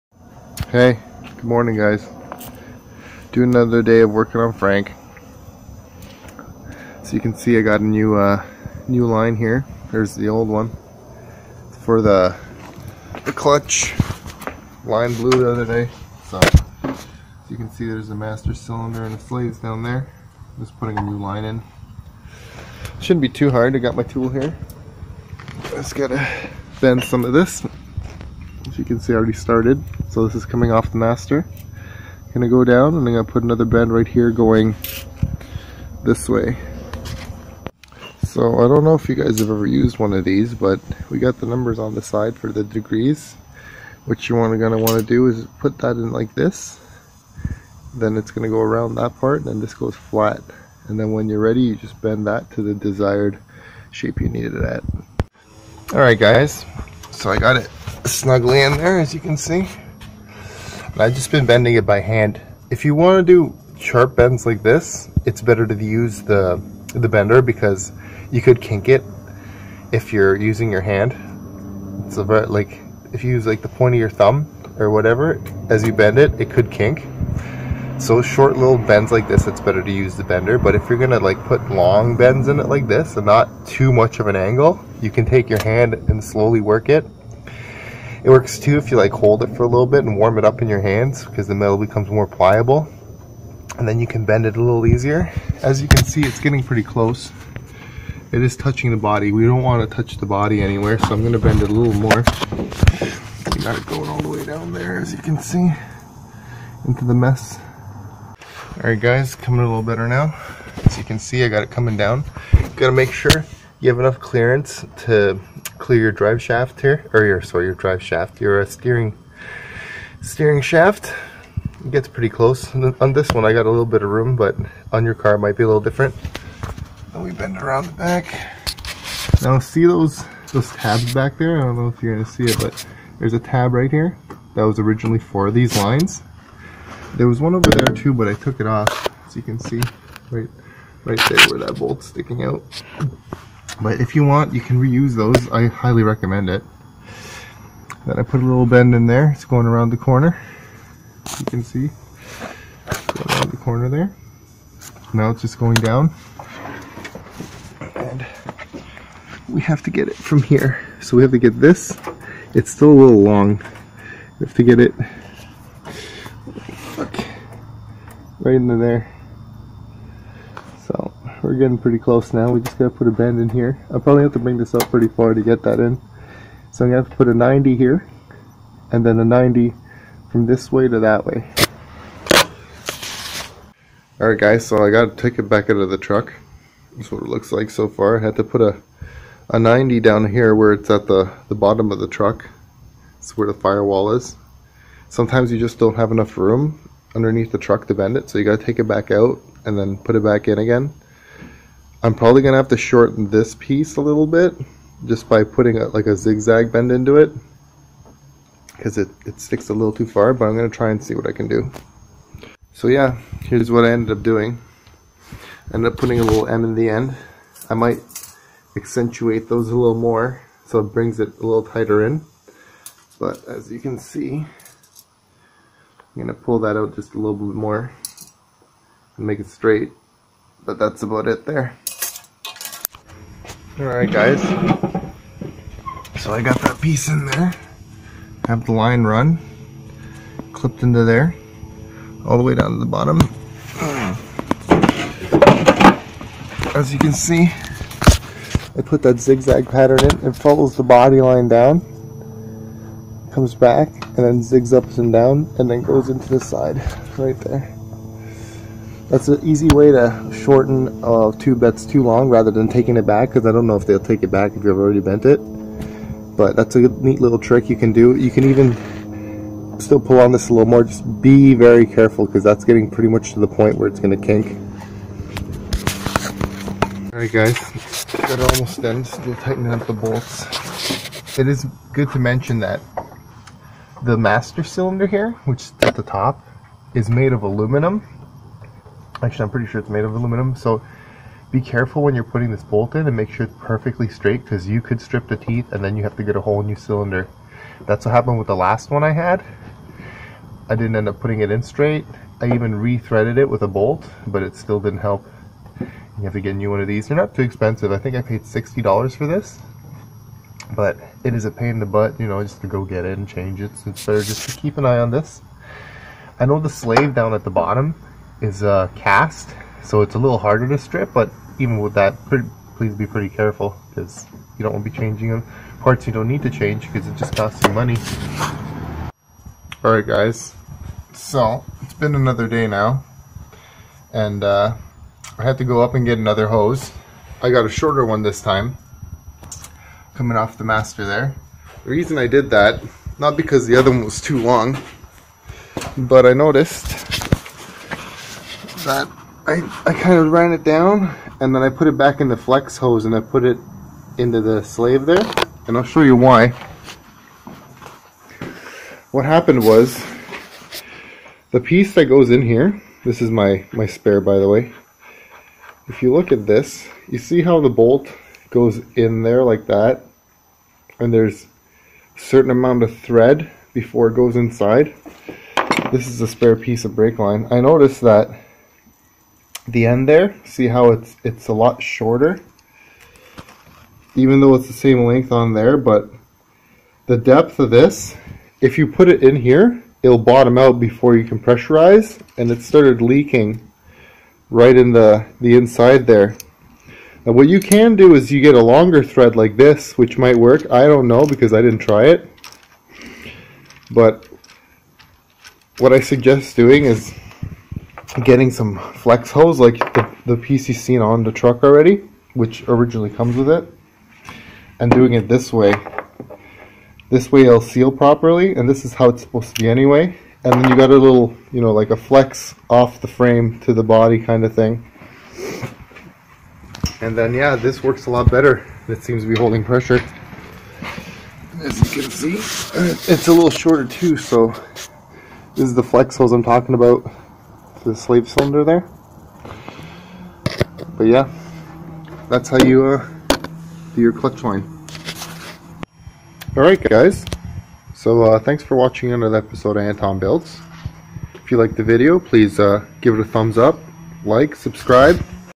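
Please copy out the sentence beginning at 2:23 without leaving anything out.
But if you want, you can reuse those.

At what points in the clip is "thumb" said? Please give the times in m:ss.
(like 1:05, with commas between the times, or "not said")
1:14, 7:33.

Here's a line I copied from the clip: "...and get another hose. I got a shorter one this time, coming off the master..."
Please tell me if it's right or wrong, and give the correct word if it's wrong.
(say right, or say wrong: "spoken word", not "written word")
right.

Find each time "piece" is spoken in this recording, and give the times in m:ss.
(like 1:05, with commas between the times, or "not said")
3:23, 3:56, 6:01, 6:16.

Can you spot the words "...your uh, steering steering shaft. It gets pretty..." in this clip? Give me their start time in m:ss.
1:58.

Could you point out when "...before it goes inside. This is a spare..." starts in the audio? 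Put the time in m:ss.
6:13.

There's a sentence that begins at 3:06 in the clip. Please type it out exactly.
That's what it looks like so far.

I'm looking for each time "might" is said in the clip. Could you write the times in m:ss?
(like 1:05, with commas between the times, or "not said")
2:05, 3:37, 6:40.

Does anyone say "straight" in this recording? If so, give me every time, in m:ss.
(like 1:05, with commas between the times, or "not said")
3:49, 4:54, 5:01.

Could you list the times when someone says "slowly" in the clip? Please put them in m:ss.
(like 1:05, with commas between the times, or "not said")
1:26.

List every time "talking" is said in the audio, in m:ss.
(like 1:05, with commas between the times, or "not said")
7:16.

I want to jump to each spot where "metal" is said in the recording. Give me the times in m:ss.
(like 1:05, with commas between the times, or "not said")
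1:31.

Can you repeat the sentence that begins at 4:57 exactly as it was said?
That's what happened with the last one I had.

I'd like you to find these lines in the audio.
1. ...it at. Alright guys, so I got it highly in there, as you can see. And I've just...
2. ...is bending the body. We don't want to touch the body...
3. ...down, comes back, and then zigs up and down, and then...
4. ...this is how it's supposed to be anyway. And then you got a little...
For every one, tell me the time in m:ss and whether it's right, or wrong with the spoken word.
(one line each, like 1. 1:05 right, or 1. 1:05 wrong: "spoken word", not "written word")
1. 0:54 wrong: "snugly", not "highly"
2. 1:38 wrong: "touching", not "bending"
3. 4:11 right
4. 6:58 right.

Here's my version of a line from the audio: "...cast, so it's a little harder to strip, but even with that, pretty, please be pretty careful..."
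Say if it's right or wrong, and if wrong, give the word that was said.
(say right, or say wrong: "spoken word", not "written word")
right.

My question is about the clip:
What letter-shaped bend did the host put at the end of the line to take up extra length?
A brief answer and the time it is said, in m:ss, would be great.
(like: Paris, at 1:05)
M, at 3:36.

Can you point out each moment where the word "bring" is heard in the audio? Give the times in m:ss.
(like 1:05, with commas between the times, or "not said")
2:54, 3:40.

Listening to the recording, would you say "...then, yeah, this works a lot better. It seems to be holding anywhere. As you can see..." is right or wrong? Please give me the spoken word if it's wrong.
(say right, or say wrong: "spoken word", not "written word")
wrong: "pressure", not "anywhere".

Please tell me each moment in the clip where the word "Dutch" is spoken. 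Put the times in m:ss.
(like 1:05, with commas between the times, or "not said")
not said.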